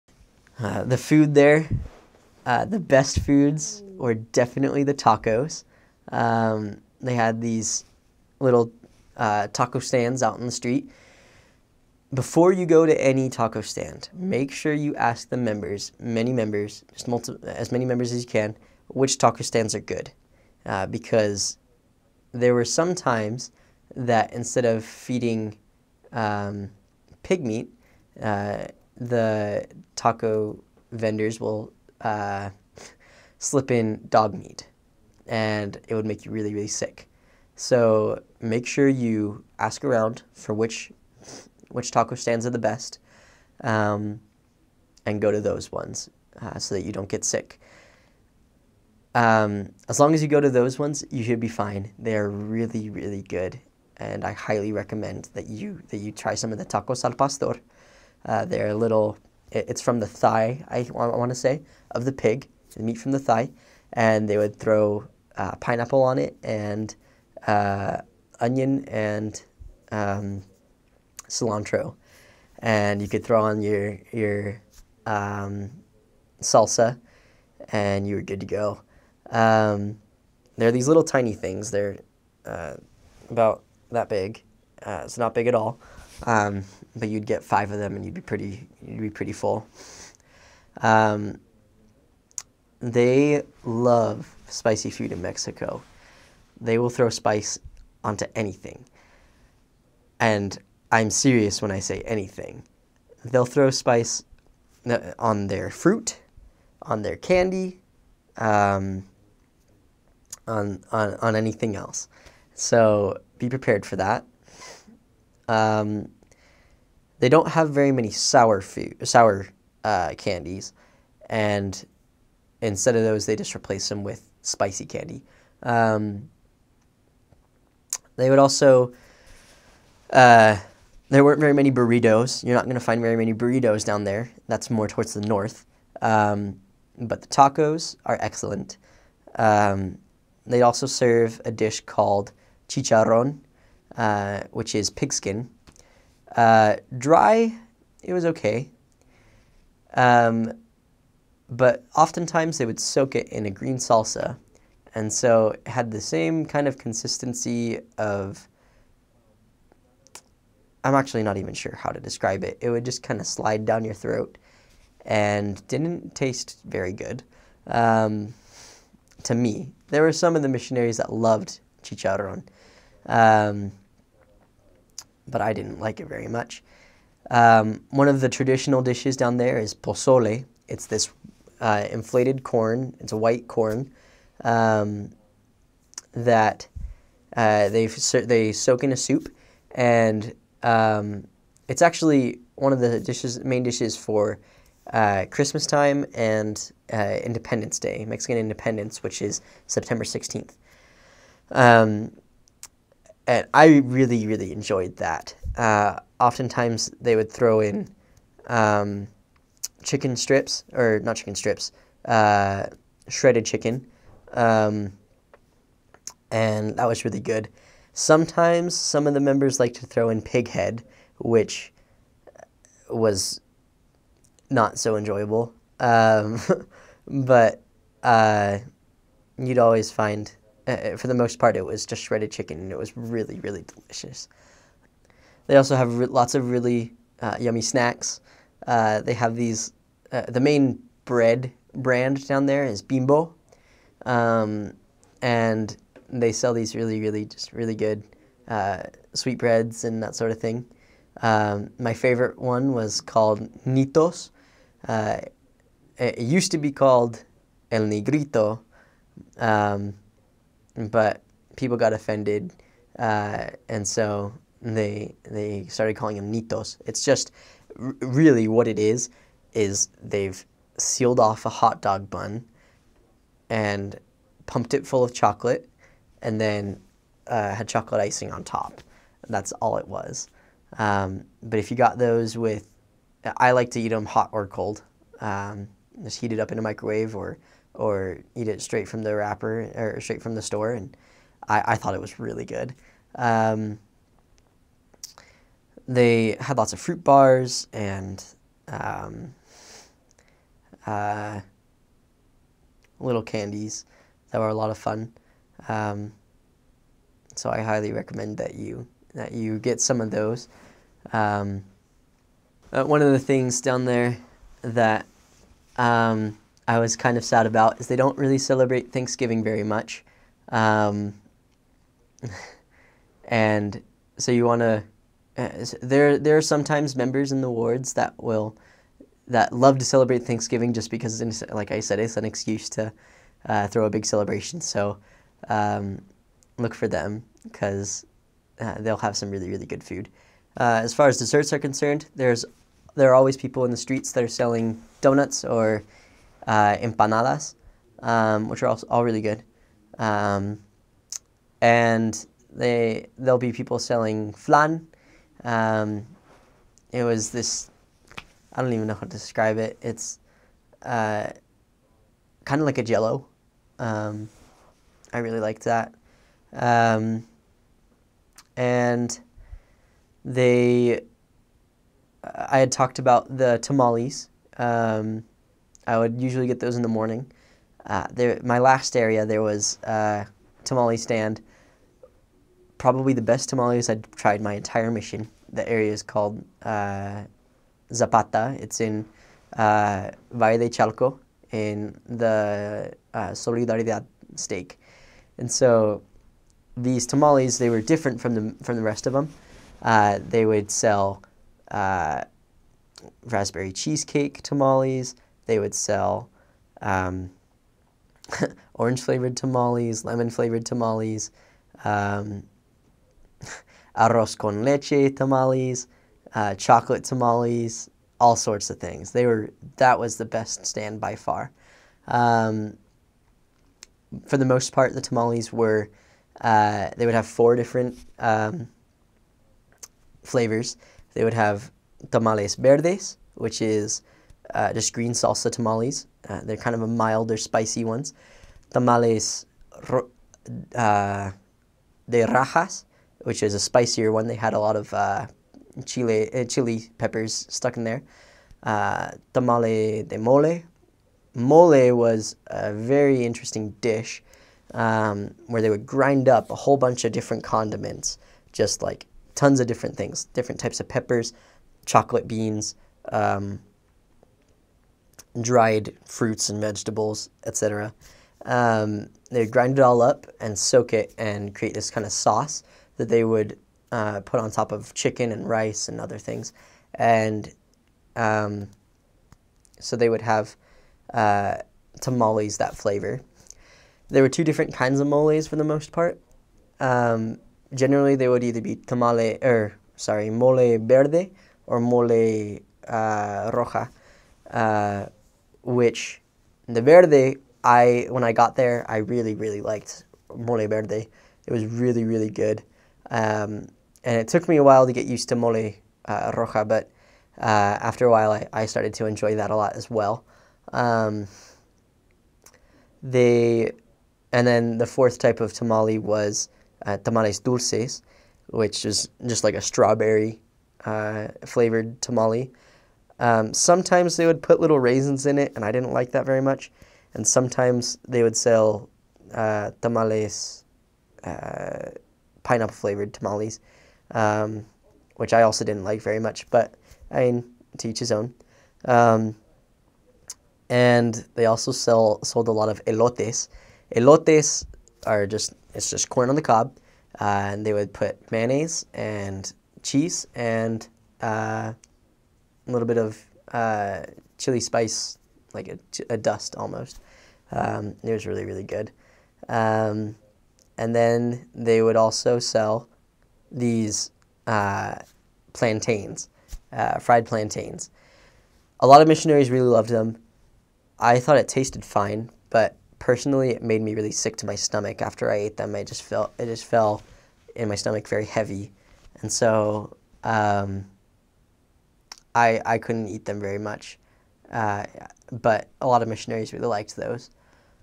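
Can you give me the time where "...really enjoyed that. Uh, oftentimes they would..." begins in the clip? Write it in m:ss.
3:24.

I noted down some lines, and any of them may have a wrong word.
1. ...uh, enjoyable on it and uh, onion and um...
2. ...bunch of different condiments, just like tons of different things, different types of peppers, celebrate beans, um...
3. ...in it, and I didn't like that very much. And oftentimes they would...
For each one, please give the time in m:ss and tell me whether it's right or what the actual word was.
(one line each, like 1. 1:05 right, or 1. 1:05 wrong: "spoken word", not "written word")
1. 1:05 wrong: "pineapple", not "enjoyable"
2. 7:36 wrong: "chocolate", not "celebrate"
3. 8:45 wrong: "sometimes", not "oftentimes".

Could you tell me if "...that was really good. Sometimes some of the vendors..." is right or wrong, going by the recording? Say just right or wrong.
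wrong.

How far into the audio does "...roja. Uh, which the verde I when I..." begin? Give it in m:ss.
8:13.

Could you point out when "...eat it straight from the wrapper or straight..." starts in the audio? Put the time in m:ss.
4:48.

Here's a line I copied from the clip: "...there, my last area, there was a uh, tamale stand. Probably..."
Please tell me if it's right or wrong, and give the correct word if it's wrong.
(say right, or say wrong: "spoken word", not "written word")
right.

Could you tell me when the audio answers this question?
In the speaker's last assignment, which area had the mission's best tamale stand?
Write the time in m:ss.
6:27.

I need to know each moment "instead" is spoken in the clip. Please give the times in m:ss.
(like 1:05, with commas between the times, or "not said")
0:24, 2:02.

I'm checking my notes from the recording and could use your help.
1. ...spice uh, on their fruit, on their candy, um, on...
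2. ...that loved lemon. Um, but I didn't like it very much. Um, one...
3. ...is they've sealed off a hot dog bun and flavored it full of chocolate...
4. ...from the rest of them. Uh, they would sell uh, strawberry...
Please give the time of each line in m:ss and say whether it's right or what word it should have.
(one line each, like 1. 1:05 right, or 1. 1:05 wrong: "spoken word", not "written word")
1. 1:43 right
2. 2:50 wrong: "chicharron", not "lemon"
3. 4:29 wrong: "pumped", not "flavored"
4. 6:38 wrong: "raspberry", not "strawberry".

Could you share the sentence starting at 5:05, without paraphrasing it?
Um, so I highly recommend that you that you get some of those.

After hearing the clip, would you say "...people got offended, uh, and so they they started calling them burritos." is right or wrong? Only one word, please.
wrong.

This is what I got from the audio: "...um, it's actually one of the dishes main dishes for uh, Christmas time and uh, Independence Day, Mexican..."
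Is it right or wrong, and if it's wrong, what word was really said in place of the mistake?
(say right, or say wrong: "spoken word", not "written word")
right.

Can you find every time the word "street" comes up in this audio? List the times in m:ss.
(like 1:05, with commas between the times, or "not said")
0:10, 5:43.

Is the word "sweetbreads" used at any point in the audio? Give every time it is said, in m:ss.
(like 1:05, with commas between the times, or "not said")
4:09.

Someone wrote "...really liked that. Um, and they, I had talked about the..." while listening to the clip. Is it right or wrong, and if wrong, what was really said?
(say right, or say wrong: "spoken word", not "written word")
right.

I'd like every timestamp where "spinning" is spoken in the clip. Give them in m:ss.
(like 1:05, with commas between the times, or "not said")
not said.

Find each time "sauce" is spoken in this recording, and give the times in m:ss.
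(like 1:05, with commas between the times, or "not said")
7:52.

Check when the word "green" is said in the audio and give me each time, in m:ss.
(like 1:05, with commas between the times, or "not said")
2:33, 7:14.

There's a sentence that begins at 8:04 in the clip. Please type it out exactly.
There were two different kinds of moles for the most part.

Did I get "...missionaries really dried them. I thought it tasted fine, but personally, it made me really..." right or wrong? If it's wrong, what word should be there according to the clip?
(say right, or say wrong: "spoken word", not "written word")
wrong: "loved", not "dried".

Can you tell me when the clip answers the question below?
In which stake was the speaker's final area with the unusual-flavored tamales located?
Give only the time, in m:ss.
6:33.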